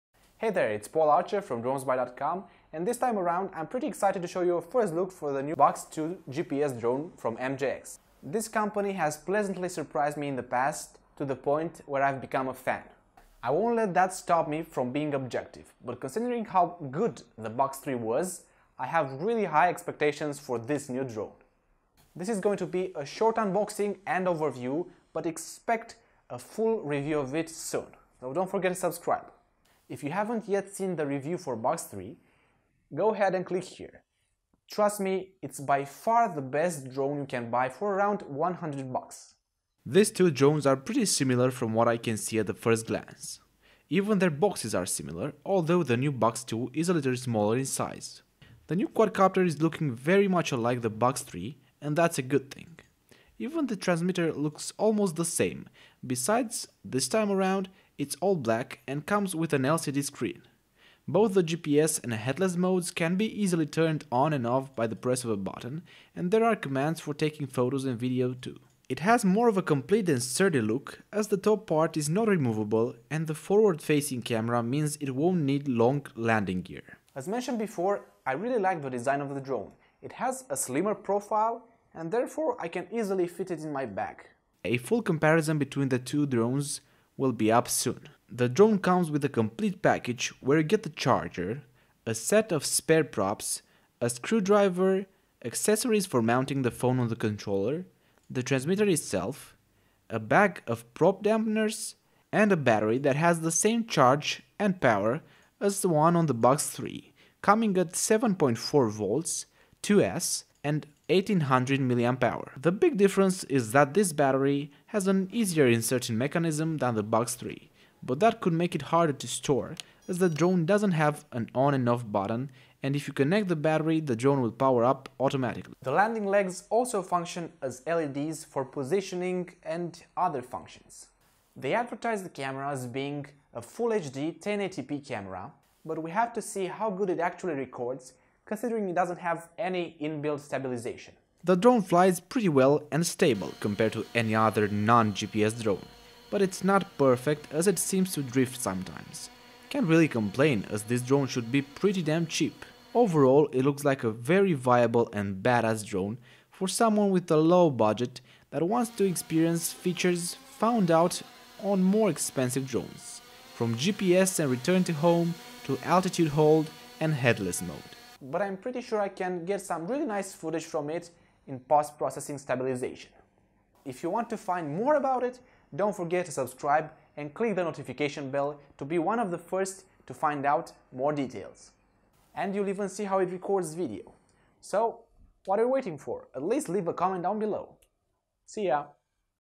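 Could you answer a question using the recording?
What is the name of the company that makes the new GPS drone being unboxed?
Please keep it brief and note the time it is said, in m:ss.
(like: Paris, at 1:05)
MJX, at 0:07.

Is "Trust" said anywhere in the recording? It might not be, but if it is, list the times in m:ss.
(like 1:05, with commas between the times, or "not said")
0:34.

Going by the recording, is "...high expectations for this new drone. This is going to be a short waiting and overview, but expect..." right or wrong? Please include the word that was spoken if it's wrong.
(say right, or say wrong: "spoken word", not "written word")
wrong: "unboxing", not "waiting".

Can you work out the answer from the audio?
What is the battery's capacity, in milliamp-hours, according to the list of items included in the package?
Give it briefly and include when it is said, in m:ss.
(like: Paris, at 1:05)
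1800 mAh, at 1:51.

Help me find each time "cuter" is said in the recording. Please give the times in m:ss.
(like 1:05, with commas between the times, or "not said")
not said.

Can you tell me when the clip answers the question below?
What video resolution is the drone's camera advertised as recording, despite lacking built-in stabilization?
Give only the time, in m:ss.
2:14.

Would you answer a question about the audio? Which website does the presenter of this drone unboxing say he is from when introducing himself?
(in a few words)
dronesby.com.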